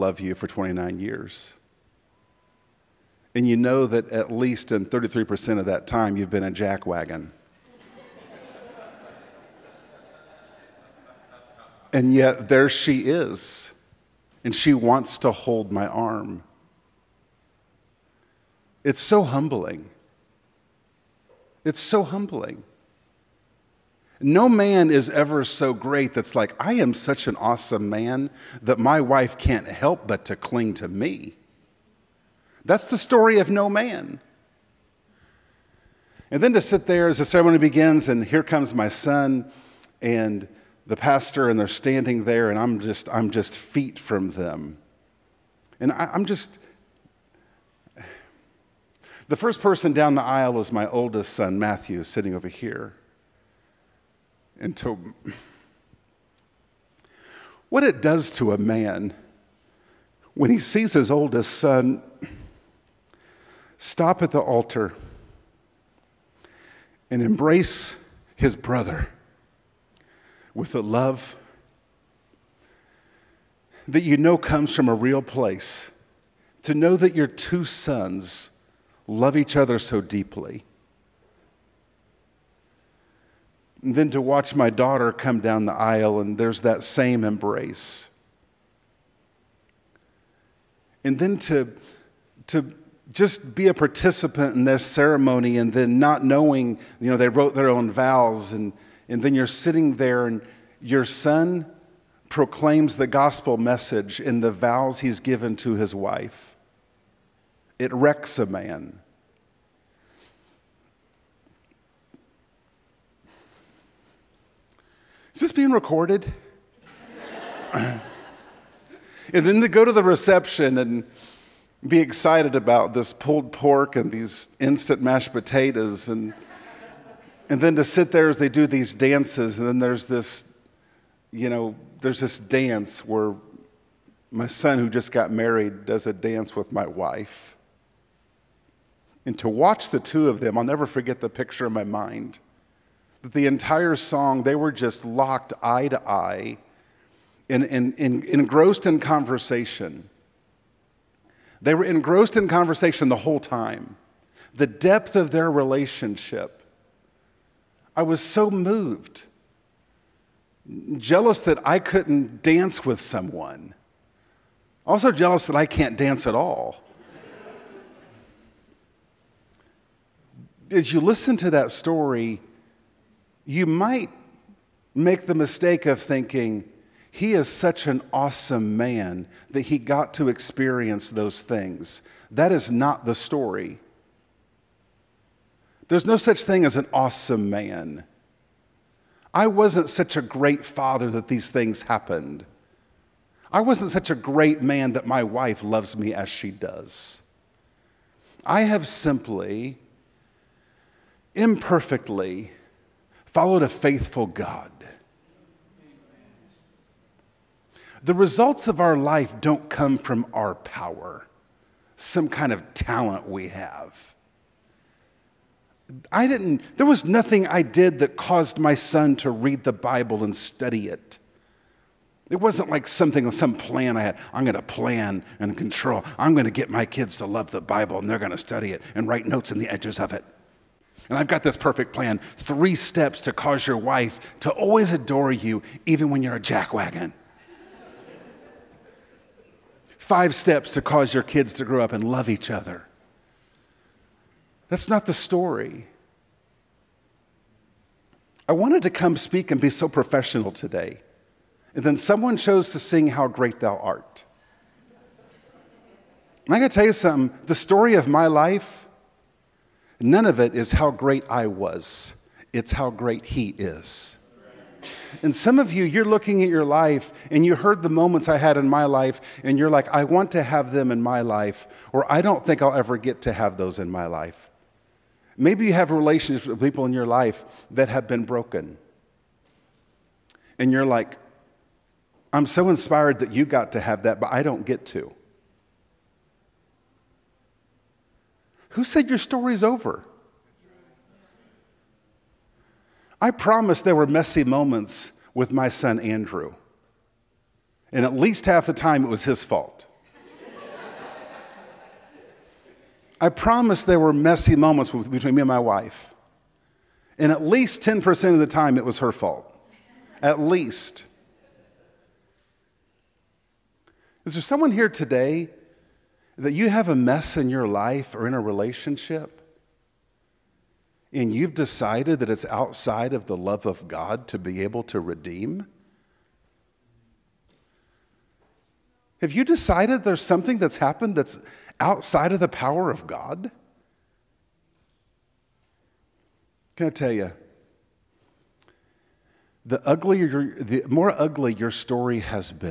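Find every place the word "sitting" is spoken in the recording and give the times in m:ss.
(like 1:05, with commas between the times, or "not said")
0:52, 1:39.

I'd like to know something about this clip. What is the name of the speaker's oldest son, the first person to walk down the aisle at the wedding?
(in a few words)
Matthew.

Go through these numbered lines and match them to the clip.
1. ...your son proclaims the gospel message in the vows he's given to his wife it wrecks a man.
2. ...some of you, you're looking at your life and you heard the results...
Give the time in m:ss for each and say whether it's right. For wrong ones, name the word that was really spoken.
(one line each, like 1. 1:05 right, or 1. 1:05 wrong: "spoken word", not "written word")
1. 1:40 right
2. 4:25 wrong: "moments", not "results".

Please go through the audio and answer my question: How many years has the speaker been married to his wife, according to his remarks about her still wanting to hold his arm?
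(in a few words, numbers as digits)
29.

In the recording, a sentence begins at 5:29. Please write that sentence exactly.
Have you decided there's something that's happened that's outside of the power of God?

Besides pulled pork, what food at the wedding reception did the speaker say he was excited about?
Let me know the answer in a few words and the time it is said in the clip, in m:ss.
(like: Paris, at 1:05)
instant mashed potatoes, at 2:04.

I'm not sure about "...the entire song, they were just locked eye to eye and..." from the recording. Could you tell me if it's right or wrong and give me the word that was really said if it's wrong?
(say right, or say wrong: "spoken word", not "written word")
right.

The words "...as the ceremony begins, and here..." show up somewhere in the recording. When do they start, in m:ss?
0:37.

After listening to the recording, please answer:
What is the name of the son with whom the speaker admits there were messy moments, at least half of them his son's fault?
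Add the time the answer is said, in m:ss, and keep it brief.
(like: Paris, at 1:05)
Andrew, at 4:55.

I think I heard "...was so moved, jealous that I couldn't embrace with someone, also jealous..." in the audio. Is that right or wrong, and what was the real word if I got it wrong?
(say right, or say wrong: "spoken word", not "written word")
wrong: "dance", not "embrace".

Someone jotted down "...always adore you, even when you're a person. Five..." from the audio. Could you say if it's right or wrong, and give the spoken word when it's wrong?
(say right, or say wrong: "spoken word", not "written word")
wrong: "jackwagon", not "person".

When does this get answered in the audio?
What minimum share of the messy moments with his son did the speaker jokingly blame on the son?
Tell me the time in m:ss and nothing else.
5:07.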